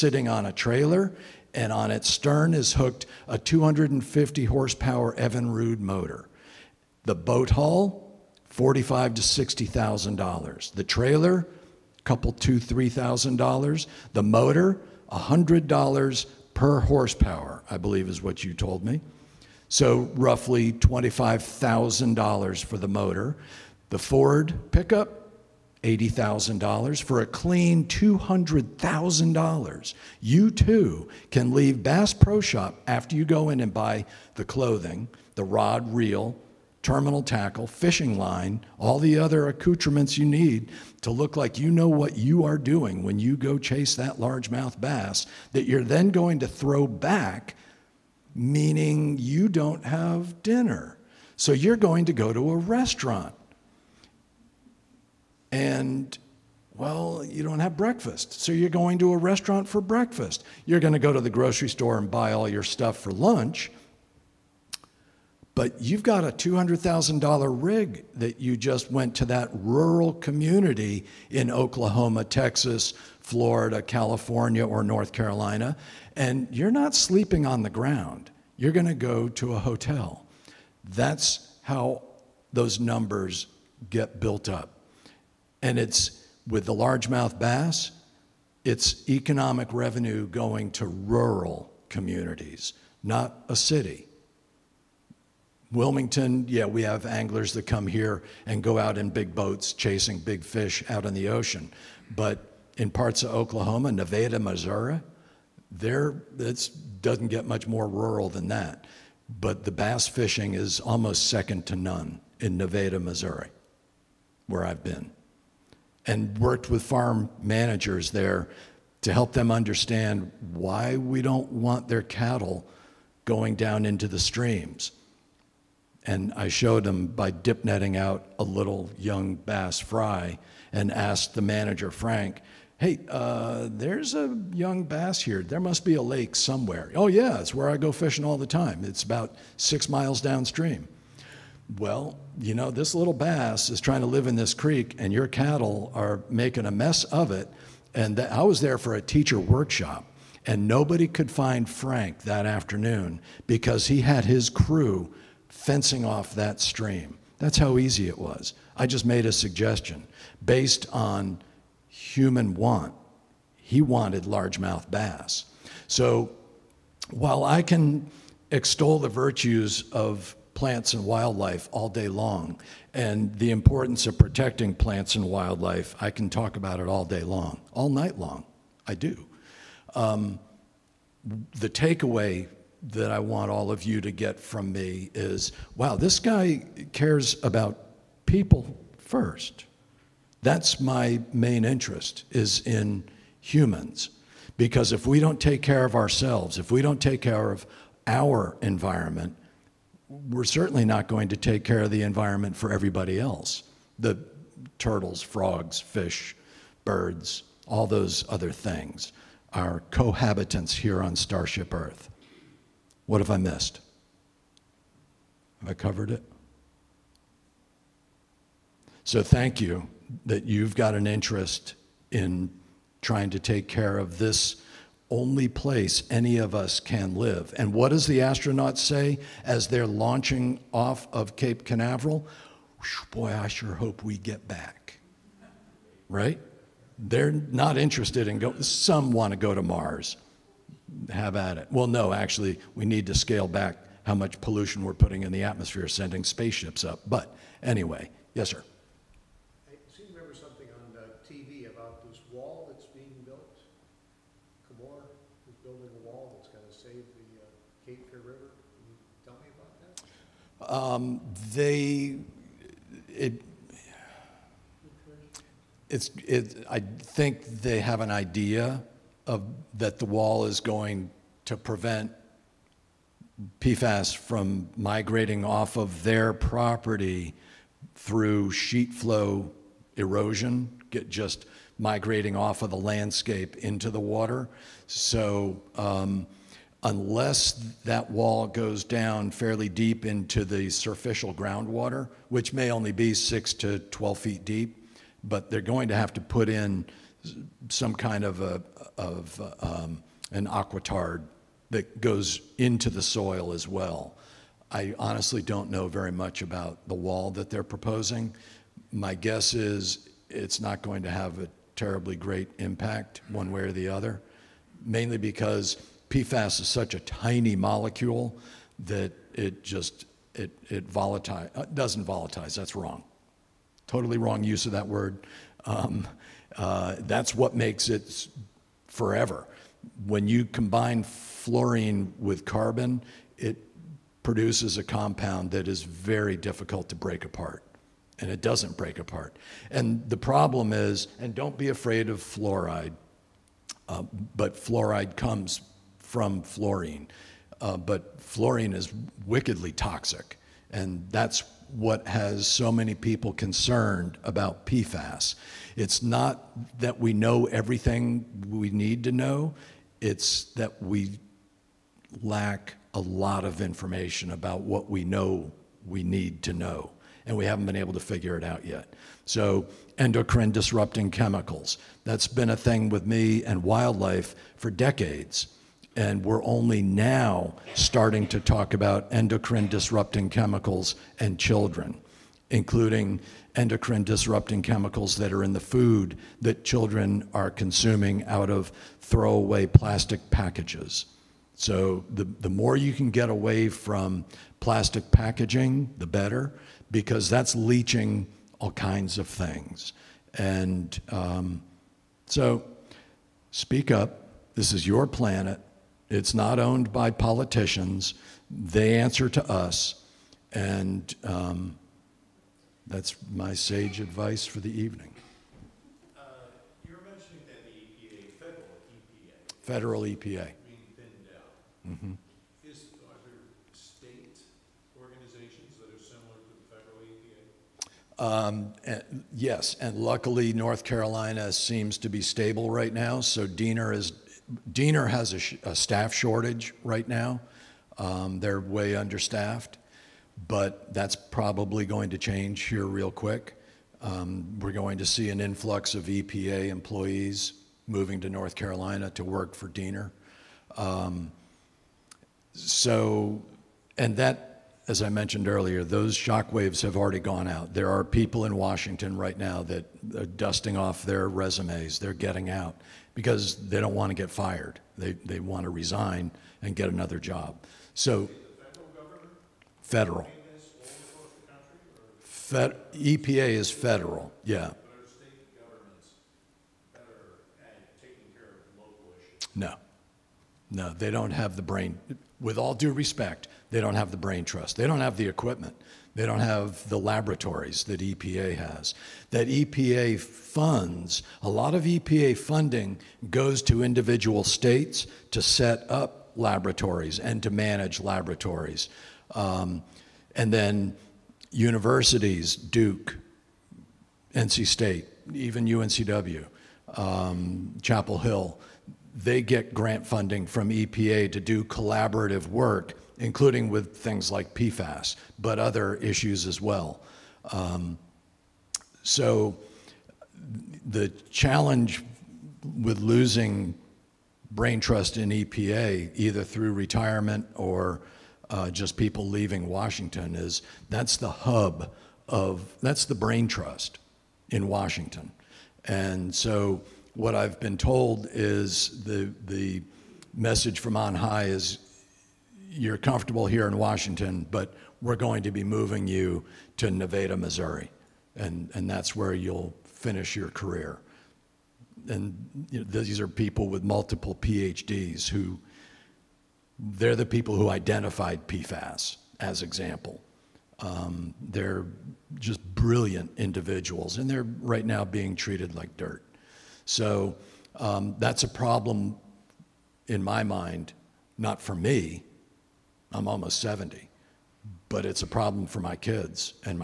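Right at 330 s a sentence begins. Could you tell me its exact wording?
When you combine fluorine with carbon, it produces a compound that is very difficult to break apart.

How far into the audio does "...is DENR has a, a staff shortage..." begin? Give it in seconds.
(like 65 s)
433 s.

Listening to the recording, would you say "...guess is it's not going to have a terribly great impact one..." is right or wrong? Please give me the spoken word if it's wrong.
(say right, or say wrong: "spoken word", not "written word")
right.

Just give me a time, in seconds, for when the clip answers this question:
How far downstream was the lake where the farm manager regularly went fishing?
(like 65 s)
139 s.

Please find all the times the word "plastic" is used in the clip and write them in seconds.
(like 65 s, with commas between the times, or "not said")
389 s, 394 s.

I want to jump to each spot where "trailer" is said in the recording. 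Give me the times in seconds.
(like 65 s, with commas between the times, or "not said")
0 s, 10 s.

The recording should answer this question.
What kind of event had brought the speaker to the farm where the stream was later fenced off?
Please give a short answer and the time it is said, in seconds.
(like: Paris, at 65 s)
teacher workshop, at 148 s.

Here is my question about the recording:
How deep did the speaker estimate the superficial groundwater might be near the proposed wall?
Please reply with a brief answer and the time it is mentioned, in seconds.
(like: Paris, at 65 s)
6 to 12 feet, at 293 s.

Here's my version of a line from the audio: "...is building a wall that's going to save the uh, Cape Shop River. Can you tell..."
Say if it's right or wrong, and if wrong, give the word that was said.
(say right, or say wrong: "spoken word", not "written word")
wrong: "Fear", not "Shop".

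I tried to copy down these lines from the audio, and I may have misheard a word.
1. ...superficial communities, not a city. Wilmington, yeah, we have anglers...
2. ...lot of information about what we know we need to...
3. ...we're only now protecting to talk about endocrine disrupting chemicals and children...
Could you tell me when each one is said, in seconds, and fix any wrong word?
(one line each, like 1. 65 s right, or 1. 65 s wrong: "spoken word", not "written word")
1. 90 s wrong: "rural", not "superficial"
2. 362 s right
3. 376 s wrong: "starting", not "protecting".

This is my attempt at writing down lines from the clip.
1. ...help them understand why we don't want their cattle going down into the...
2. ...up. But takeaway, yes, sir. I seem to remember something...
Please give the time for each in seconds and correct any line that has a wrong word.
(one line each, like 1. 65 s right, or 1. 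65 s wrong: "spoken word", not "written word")
1. 119 s right
2. 246 s wrong: "anyway", not "takeaway".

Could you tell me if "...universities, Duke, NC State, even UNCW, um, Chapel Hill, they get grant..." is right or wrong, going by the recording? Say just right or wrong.
right.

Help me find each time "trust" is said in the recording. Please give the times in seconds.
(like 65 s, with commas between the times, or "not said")
484 s, 524 s, 533 s.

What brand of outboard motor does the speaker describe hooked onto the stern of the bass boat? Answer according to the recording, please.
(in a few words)
Evinrude.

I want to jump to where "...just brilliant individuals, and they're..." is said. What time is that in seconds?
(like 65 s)
562 s.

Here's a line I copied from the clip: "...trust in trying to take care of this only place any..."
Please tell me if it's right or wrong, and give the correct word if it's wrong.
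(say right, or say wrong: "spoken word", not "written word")
wrong: "interest", not "trust".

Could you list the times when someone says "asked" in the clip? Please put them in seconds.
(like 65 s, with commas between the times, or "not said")
130 s.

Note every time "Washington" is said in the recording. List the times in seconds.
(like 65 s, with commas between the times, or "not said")
458 s, 529 s, 534 s, 543 s.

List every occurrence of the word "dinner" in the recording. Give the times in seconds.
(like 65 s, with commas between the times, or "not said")
50 s.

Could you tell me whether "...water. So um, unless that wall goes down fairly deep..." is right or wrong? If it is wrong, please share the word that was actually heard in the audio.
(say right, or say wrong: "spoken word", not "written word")
right.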